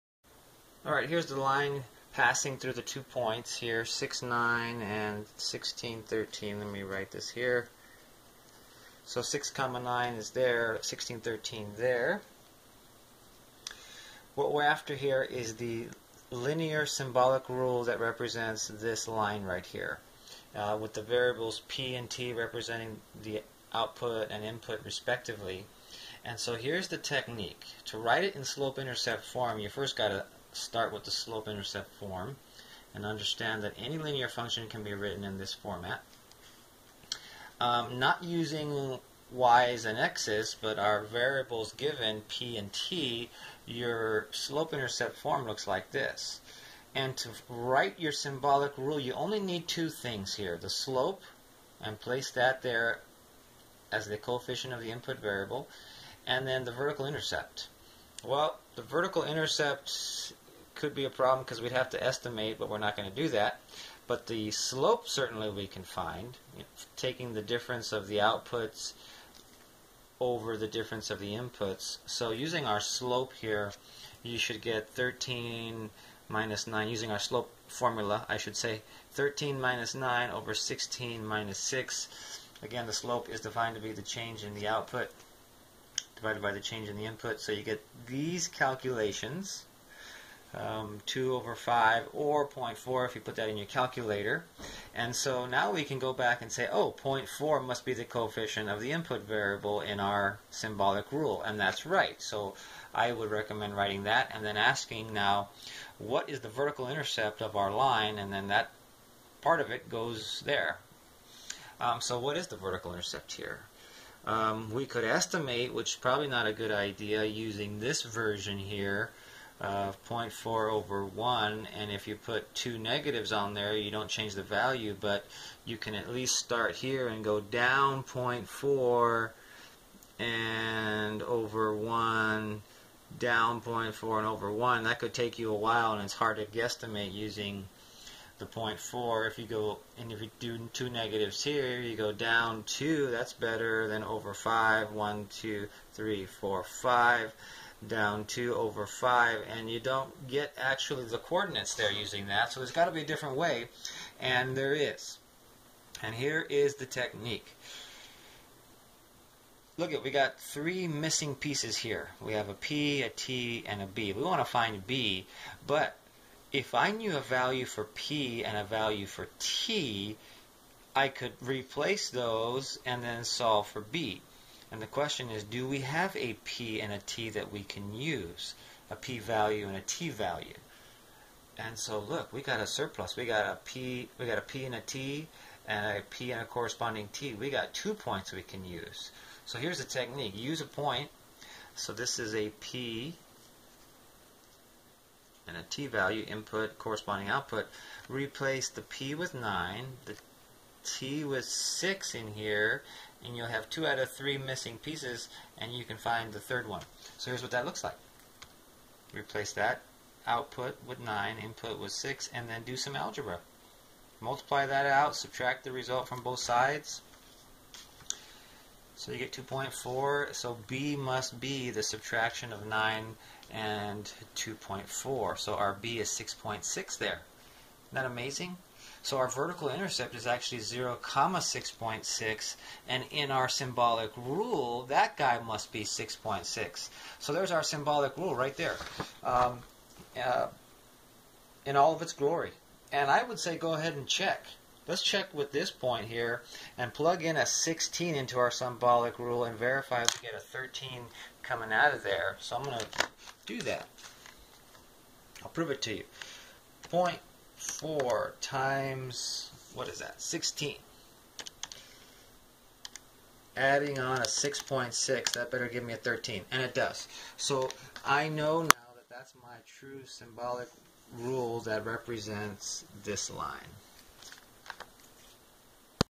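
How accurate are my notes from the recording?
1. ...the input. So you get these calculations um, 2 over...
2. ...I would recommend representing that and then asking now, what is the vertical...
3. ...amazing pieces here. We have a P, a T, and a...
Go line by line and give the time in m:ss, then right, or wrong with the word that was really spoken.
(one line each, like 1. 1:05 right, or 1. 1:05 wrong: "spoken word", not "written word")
1. 1:26 right
2. 1:42 wrong: "writing", not "representing"
3. 2:40 wrong: "missing", not "amazing".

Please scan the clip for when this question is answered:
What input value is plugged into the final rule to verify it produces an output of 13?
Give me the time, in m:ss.
4:06.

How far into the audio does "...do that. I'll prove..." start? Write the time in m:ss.
4:13.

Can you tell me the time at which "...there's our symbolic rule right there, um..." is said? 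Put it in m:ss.
3:57.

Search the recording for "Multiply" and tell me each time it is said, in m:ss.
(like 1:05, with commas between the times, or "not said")
3:34.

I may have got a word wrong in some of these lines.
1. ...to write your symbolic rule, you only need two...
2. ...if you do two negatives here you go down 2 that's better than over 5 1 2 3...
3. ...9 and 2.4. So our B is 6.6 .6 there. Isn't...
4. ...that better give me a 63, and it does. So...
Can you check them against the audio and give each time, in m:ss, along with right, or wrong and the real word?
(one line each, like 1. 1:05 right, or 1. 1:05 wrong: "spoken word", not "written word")
1. 0:47 right
2. 2:20 right
3. 3:42 right
4. 4:25 wrong: "13", not "63".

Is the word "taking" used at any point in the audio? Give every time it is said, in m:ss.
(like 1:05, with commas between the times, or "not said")
1:06.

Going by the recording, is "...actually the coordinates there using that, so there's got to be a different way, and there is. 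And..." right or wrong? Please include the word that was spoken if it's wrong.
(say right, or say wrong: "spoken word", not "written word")
right.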